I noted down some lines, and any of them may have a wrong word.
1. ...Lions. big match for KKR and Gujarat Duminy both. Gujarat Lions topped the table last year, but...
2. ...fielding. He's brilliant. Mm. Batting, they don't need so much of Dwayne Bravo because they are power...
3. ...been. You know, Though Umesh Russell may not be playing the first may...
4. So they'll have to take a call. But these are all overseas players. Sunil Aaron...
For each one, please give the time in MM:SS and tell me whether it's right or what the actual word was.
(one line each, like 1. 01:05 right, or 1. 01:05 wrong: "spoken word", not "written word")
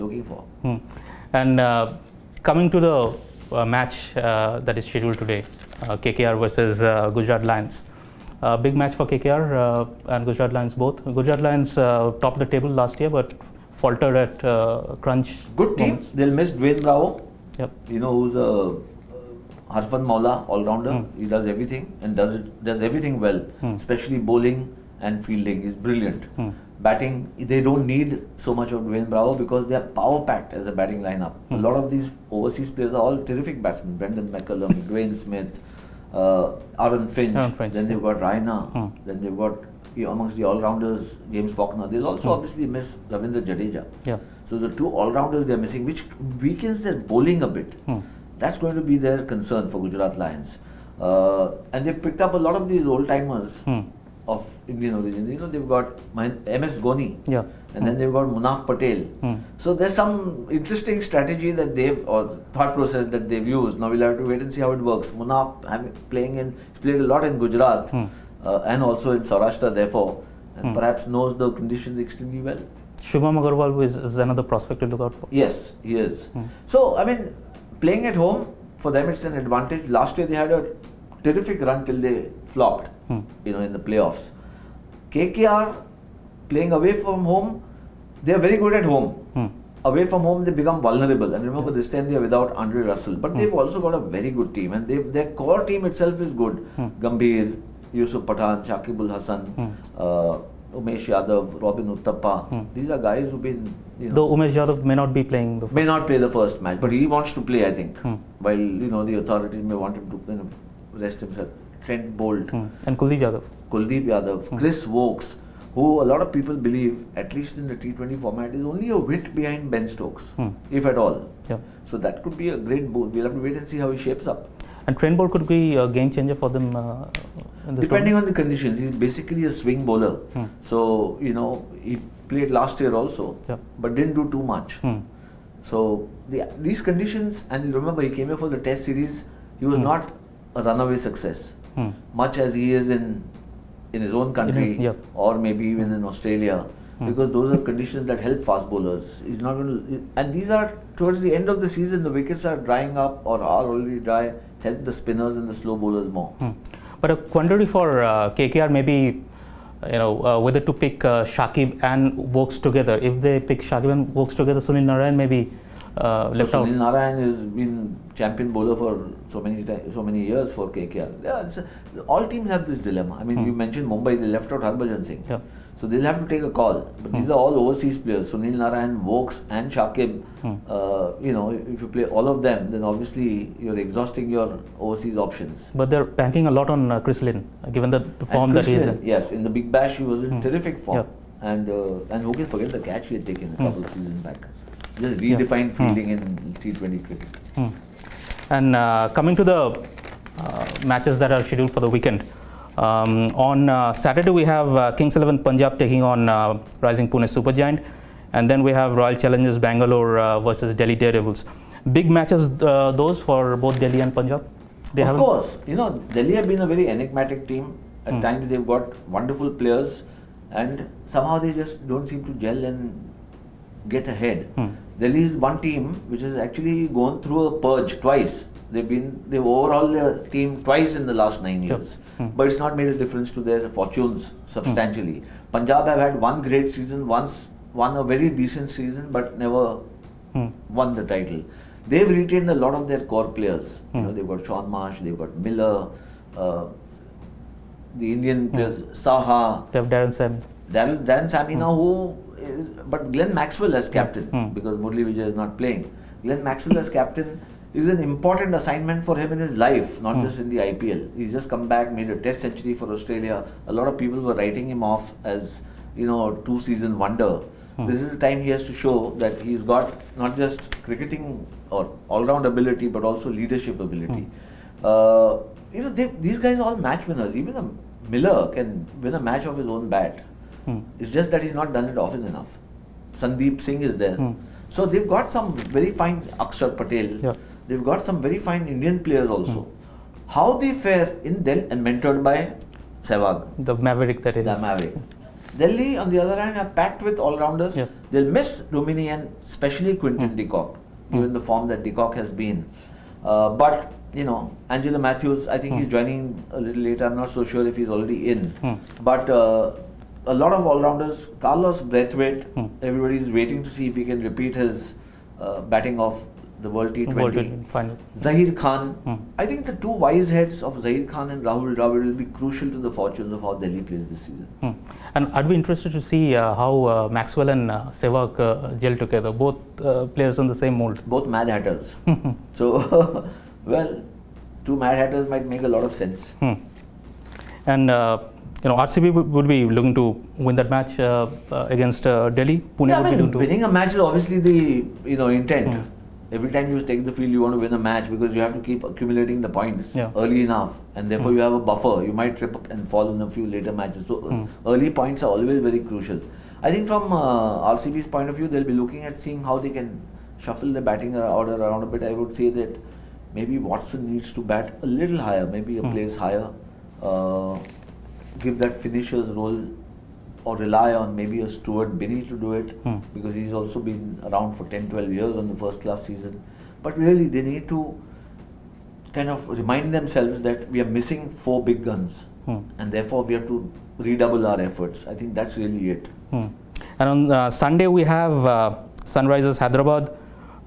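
1. 00:07 wrong: "Lions", not "Duminy"
2. 00:25 right
3. 01:43 wrong: "Yadav", not "Russell"
4. 02:55 wrong: "Narayan", not "Aaron".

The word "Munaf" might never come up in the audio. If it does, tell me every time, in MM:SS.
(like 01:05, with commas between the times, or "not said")
00:58, 01:05.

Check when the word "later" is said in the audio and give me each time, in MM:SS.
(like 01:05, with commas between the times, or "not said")
05:06, 05:53.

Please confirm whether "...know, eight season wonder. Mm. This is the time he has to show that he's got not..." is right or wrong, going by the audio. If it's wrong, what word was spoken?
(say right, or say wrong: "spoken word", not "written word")
wrong: "two", not "eight".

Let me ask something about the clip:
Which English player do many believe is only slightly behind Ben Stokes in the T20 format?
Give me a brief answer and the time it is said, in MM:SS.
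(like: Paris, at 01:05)
Chris Woakes, at 01:54.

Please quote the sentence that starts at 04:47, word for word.
Yeah they've got some very fine Indian players also.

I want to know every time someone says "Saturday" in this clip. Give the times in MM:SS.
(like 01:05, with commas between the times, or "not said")
03:23.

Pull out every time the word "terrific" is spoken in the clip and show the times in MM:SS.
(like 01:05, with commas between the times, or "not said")
00:33, 01:21, 03:10.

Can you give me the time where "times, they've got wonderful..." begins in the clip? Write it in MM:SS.
03:38.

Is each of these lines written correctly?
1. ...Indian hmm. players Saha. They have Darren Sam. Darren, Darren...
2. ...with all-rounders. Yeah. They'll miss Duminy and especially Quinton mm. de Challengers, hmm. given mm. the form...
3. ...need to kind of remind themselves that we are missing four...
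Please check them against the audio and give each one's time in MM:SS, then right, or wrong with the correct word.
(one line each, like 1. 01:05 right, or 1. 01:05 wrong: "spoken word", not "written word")
1. 04:08 right
2. 04:57 wrong: "Kock", not "Challengers"
3. 06:17 right.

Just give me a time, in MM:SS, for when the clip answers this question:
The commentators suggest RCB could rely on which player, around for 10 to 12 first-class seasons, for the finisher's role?
06:11.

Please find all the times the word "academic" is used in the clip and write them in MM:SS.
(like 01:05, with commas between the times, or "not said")
not said.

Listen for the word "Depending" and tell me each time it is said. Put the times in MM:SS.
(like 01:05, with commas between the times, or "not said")
02:07.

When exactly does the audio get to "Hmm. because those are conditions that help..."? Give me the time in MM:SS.
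02:27.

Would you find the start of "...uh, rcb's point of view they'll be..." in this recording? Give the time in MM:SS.
05:57.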